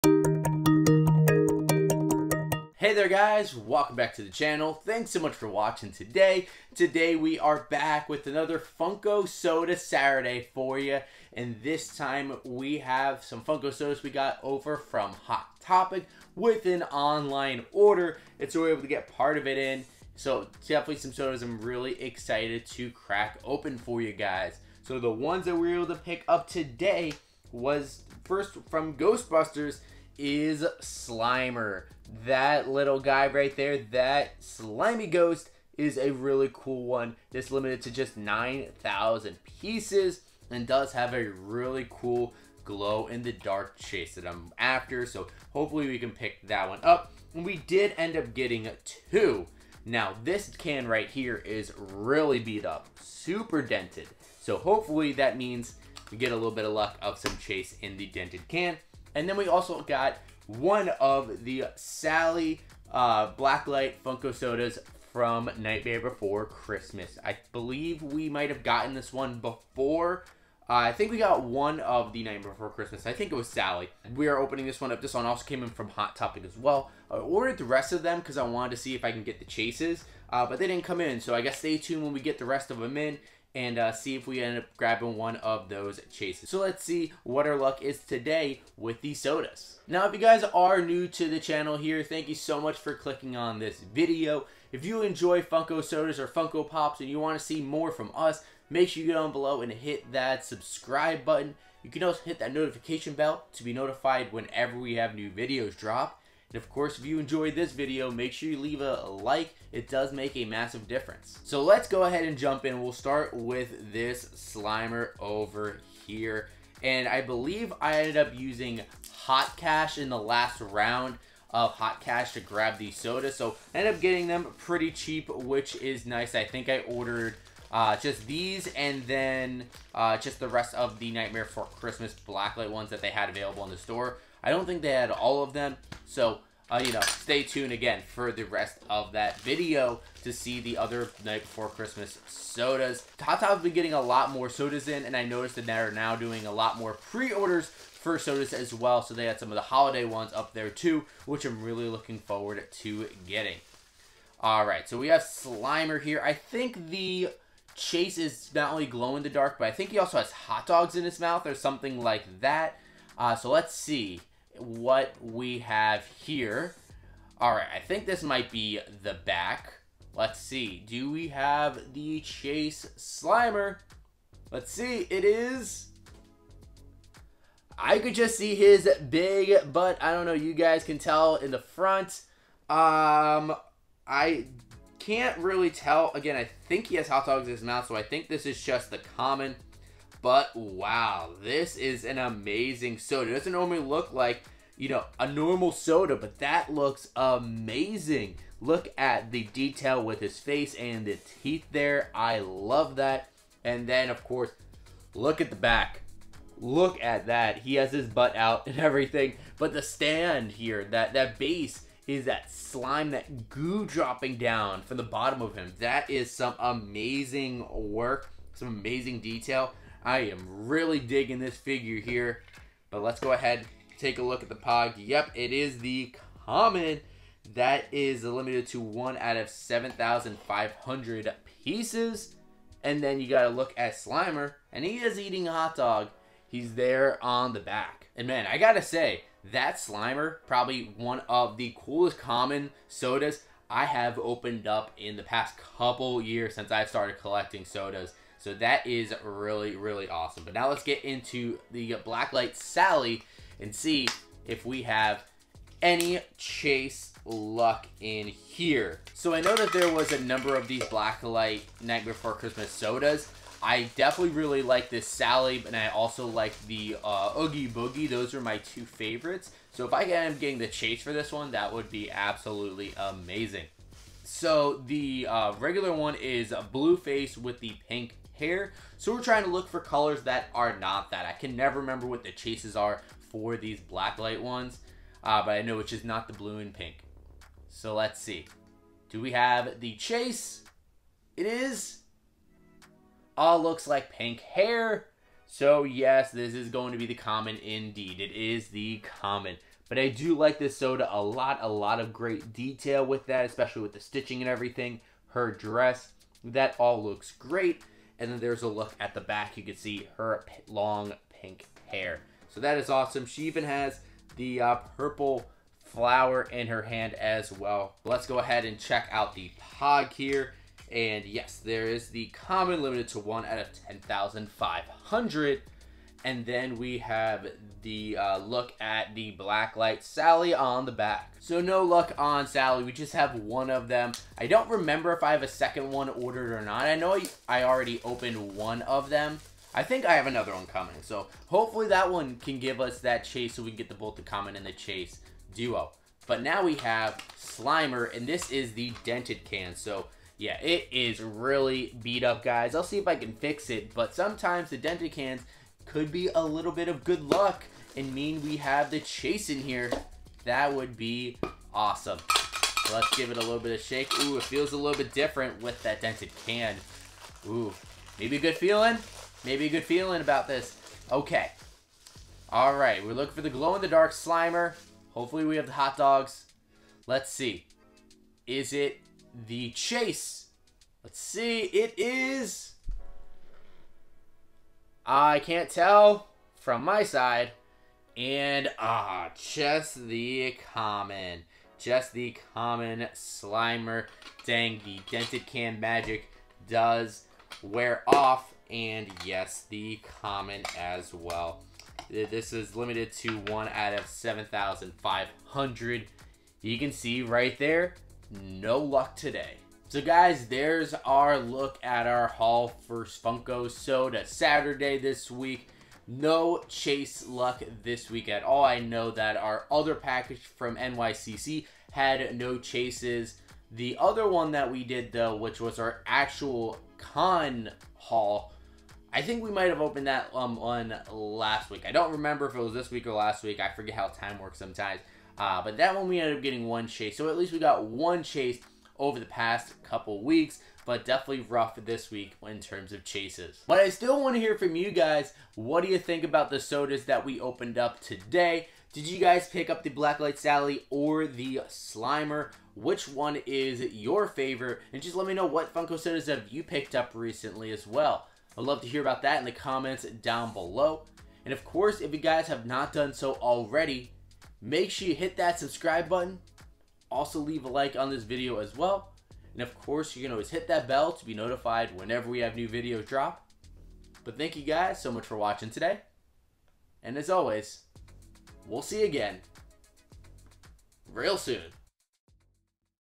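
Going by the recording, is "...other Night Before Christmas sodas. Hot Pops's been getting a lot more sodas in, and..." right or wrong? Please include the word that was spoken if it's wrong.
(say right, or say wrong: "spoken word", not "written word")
wrong: "Top", not "Pops".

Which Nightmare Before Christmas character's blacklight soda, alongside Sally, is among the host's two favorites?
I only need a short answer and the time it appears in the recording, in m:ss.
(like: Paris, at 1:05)
Oogie Boogie, at 4:27.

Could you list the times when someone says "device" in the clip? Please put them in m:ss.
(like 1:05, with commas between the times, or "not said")
not said.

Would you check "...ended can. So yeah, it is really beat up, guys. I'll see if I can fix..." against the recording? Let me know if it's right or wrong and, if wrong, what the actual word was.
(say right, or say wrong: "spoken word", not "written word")
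wrong: "dented", not "ended".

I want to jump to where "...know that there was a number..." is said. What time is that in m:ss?
4:19.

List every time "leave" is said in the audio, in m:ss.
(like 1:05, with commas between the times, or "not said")
1:48, 7:47.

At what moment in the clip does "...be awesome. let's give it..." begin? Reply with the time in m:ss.
6:00.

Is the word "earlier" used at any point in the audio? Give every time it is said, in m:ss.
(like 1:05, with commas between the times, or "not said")
not said.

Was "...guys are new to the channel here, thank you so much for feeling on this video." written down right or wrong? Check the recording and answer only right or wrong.
wrong.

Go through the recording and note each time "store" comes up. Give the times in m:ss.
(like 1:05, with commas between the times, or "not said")
2:13.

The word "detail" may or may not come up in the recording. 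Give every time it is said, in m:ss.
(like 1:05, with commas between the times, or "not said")
3:19, 3:39, 5:02.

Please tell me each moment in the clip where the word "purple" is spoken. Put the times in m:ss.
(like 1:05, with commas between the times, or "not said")
5:14.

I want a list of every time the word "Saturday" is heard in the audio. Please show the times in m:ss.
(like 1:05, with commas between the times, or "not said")
0:09, 6:54.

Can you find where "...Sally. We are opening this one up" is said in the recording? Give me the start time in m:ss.
1:13.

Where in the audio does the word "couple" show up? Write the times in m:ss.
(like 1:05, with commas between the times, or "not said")
4:05, 7:19.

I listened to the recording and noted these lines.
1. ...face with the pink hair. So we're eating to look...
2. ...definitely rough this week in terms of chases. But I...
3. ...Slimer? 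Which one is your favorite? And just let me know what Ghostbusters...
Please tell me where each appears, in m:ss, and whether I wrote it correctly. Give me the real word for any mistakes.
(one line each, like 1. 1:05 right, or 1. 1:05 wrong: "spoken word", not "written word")
1. 4:36 wrong: "trying", not "eating"
2. 7:21 right
3. 7:31 wrong: "Funko", not "Ghostbusters".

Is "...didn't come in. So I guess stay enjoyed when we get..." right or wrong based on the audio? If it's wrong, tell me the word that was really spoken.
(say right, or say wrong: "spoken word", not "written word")
wrong: "tuned", not "enjoyed".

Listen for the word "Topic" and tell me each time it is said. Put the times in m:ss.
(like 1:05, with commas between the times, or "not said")
0:15, 1:16.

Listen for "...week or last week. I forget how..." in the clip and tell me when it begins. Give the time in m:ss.
7:12.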